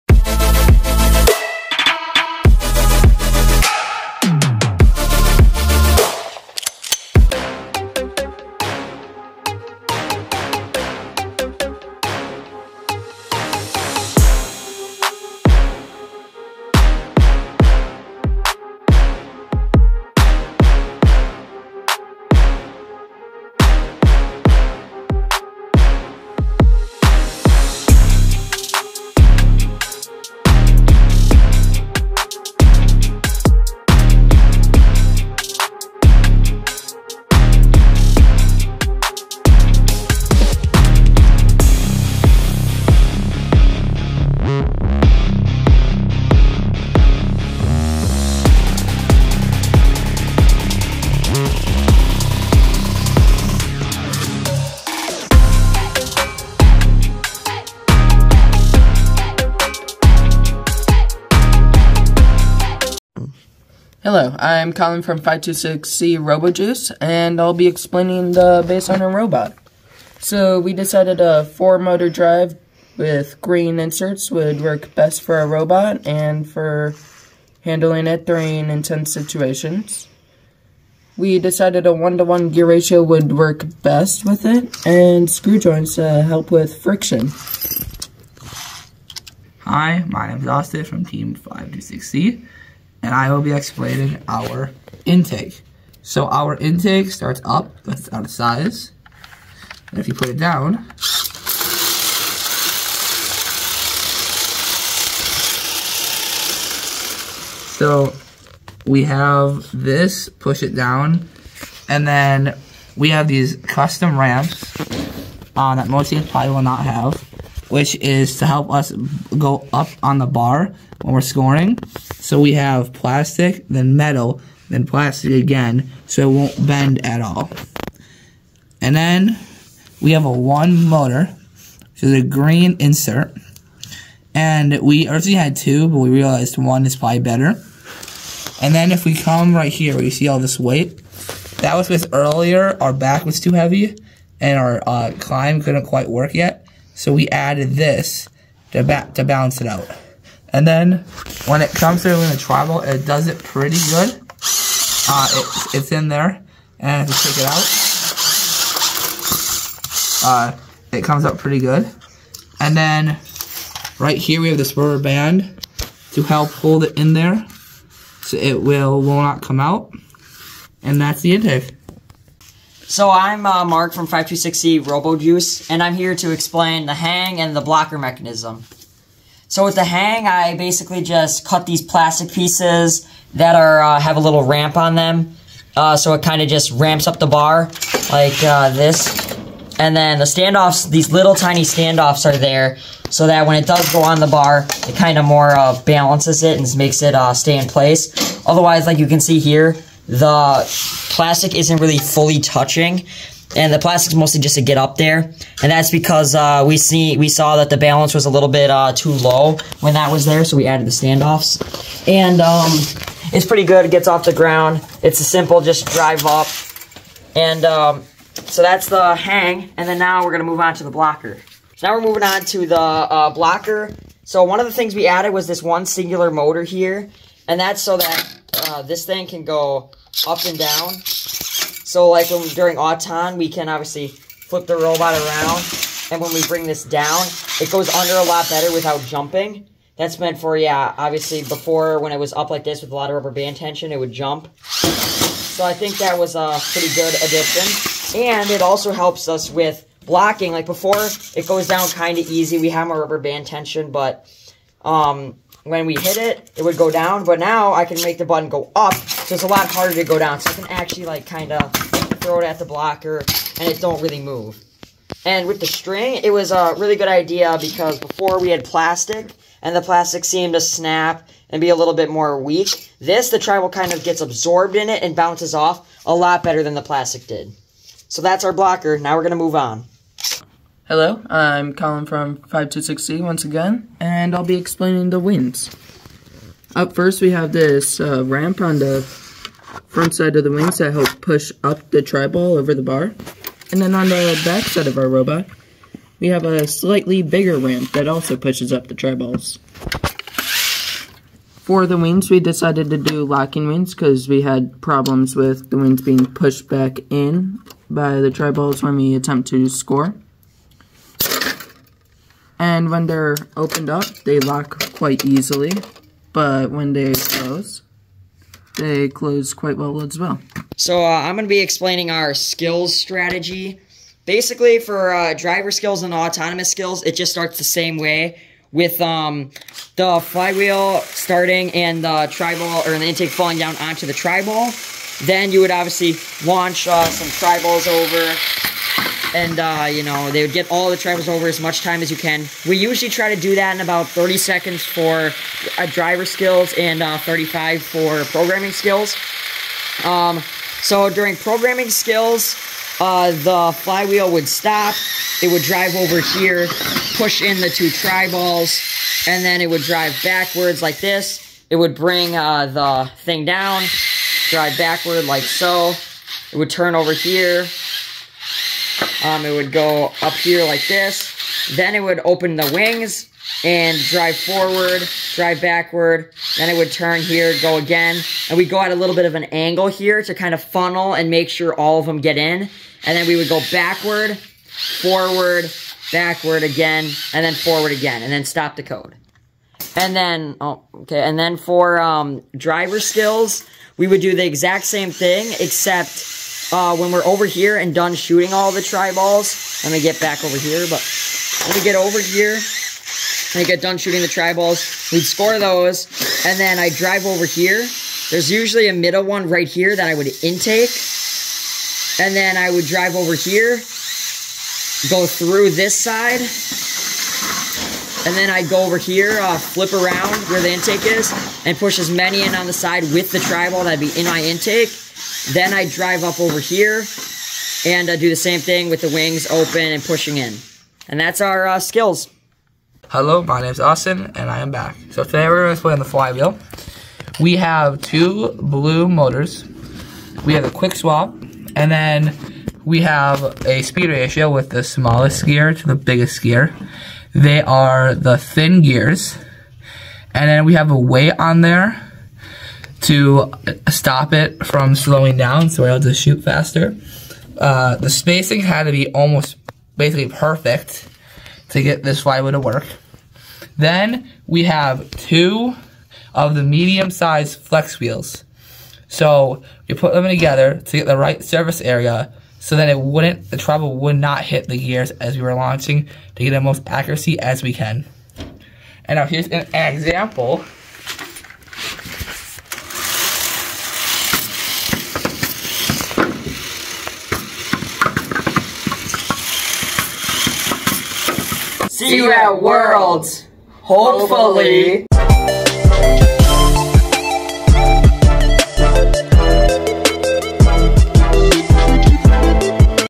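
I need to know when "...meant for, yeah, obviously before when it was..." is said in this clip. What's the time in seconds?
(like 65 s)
240 s.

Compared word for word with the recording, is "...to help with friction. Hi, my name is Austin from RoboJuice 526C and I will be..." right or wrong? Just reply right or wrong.
wrong.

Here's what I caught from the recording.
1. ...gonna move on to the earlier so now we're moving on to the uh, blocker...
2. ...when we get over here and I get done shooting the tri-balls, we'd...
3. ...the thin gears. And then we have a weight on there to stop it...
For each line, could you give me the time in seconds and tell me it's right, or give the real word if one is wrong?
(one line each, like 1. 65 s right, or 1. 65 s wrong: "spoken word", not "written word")
1. 220 s wrong: "blocker", not "earlier"
2. 401 s right
3. 448 s right.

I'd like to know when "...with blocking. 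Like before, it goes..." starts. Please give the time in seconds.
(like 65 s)
249 s.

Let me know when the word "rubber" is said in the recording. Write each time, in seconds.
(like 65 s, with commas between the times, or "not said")
164 s, 243 s, 252 s.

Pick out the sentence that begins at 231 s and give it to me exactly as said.
So like when during Auton, we can obviously flip the robot around.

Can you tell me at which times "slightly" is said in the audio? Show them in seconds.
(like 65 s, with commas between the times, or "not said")
296 s.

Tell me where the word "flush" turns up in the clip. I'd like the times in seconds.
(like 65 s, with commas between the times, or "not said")
not said.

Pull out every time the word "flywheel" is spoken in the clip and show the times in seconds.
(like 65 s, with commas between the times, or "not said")
330 s, 353 s, 436 s, 462 s.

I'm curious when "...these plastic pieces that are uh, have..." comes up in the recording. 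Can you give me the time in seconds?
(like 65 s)
181 s.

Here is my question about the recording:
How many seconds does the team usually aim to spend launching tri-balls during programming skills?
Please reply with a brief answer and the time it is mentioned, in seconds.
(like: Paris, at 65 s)
35, at 347 s.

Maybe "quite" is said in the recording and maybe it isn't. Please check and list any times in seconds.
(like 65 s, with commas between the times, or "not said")
145 s, 314 s, 319 s.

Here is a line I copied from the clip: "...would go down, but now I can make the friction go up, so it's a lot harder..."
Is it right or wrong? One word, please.
wrong.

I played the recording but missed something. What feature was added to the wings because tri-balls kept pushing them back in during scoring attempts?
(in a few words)
Locking.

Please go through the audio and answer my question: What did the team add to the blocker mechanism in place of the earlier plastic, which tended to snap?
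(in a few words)
String.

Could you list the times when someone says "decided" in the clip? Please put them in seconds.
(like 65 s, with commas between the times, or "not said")
70 s, 81 s, 302 s.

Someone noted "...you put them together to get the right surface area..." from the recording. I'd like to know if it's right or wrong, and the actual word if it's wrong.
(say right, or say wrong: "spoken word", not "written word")
right.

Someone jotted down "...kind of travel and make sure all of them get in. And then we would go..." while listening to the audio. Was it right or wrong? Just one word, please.
wrong.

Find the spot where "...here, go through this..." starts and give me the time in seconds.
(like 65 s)
413 s.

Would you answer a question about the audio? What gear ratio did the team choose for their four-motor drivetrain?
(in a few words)
1:1.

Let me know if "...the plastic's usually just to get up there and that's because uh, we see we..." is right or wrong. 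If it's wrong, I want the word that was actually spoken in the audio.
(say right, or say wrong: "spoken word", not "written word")
wrong: "mostly", not "usually".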